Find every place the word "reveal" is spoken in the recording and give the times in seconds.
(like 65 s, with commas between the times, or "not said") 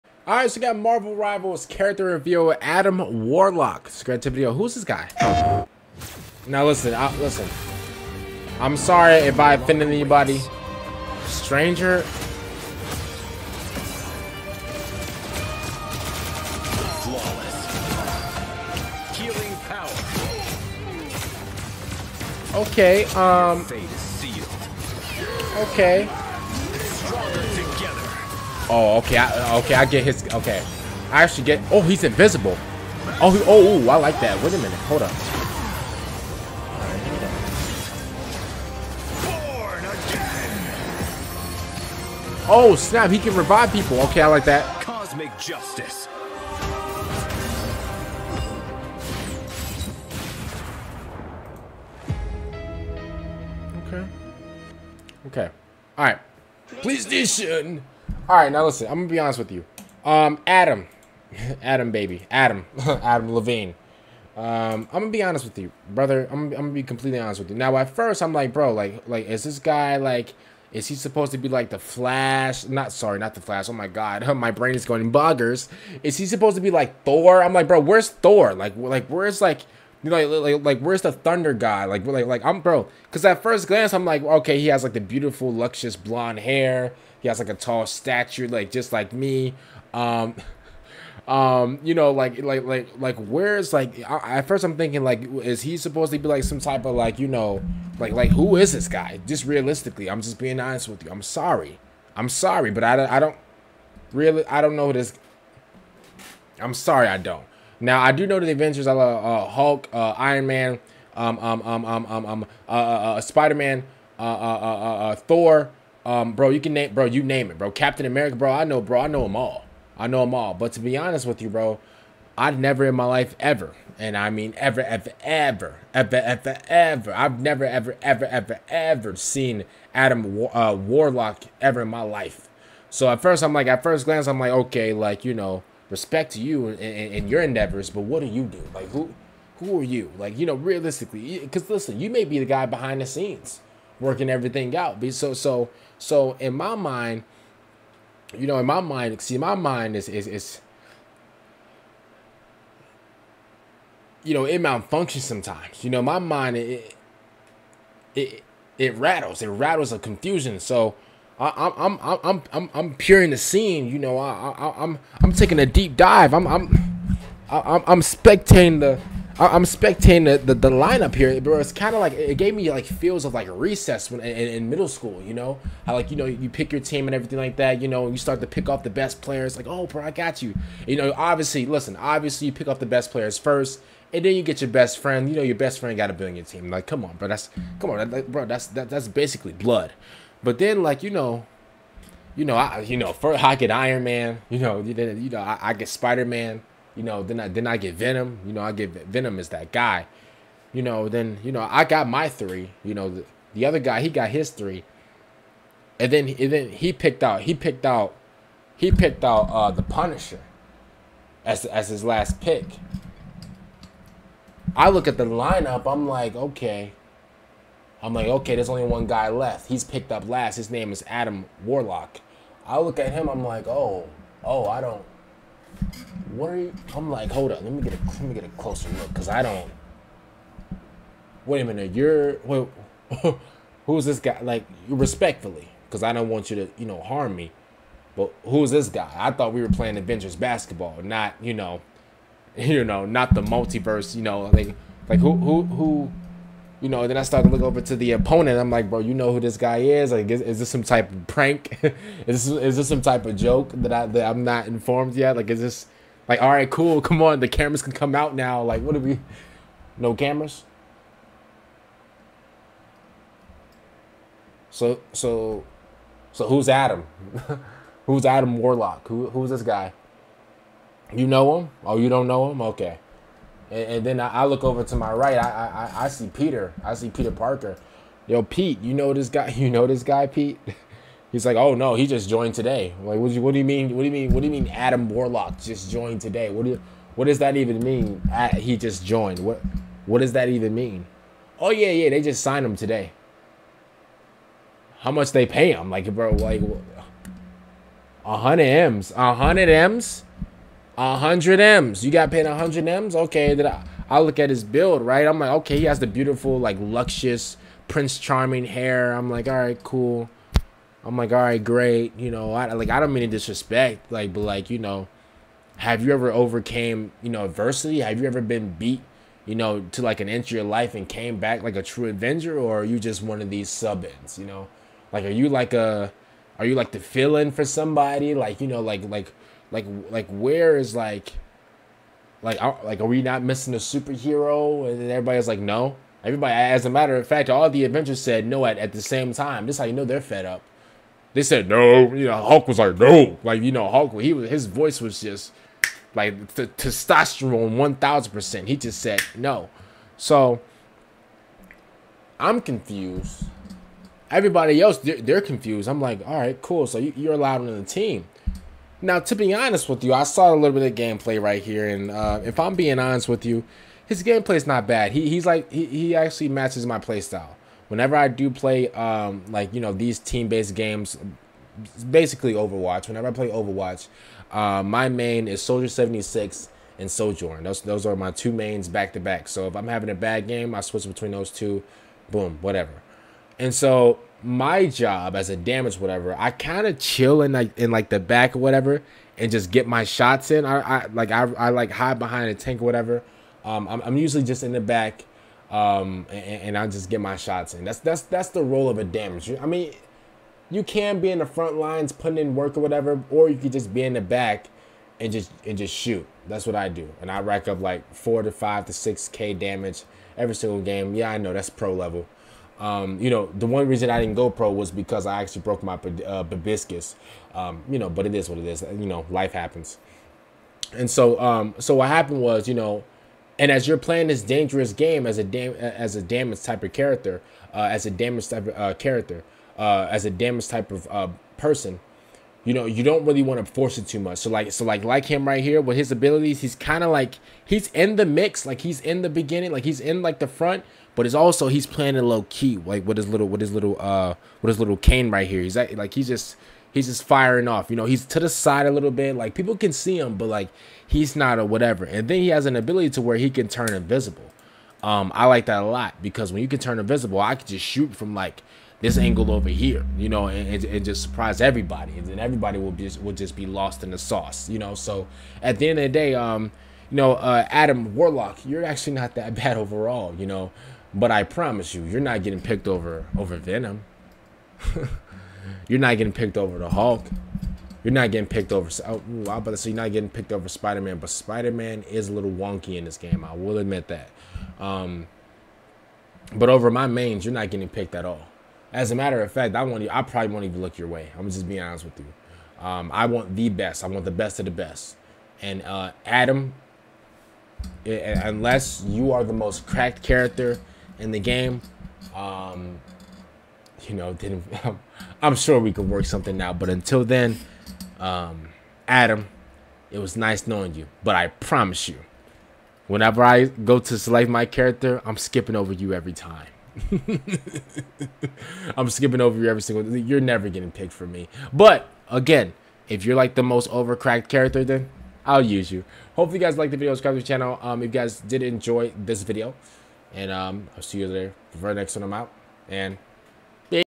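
2 s.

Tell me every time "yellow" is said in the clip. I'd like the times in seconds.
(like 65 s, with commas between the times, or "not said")
not said.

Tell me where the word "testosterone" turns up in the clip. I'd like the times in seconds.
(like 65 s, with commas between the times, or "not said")
346 s.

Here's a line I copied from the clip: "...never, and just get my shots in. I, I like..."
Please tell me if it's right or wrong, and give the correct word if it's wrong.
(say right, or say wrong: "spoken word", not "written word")
wrong: "whatever", not "never".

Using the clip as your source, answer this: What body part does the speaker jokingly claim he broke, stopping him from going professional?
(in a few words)
bibiscus.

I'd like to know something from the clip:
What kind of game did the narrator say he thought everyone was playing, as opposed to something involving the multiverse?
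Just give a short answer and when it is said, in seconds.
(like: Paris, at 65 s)
Avengers basketball, at 239 s.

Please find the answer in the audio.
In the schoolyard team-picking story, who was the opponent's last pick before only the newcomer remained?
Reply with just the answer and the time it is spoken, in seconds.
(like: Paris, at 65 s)
the Punisher, at 209 s.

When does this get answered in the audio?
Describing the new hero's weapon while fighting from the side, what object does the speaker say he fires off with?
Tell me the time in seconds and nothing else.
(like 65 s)
444 s.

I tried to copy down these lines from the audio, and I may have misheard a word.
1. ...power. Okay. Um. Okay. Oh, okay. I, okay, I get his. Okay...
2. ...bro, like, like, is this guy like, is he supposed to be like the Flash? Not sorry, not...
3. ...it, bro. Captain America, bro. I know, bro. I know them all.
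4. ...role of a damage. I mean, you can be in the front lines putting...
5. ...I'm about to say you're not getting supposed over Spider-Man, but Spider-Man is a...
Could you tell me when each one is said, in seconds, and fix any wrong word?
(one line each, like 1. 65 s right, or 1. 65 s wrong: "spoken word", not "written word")
1. 22 s right
2. 68 s right
3. 117 s right
4. 398 s right
5. 479 s wrong: "picked", not "supposed".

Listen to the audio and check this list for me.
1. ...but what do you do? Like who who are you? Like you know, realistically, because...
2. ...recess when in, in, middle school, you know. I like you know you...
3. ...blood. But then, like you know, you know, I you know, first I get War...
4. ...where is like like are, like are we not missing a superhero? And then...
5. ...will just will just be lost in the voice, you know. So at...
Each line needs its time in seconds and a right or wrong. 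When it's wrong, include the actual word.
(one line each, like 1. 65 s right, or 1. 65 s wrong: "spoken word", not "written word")
1. 137 s right
2. 173 s right
3. 189 s wrong: "Iron", not "War"
4. 330 s right
5. 462 s wrong: "sauce", not "voice".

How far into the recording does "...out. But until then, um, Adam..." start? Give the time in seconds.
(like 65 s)
506 s.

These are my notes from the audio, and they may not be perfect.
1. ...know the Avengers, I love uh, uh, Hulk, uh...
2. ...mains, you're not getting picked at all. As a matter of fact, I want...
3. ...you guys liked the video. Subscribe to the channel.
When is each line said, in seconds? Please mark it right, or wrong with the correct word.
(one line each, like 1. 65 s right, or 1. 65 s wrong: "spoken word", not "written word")
1. 108 s right
2. 487 s right
3. 526 s right.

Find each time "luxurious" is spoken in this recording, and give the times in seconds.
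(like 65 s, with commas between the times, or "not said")
85 s, 306 s.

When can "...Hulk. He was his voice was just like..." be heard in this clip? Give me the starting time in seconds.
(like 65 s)
343 s.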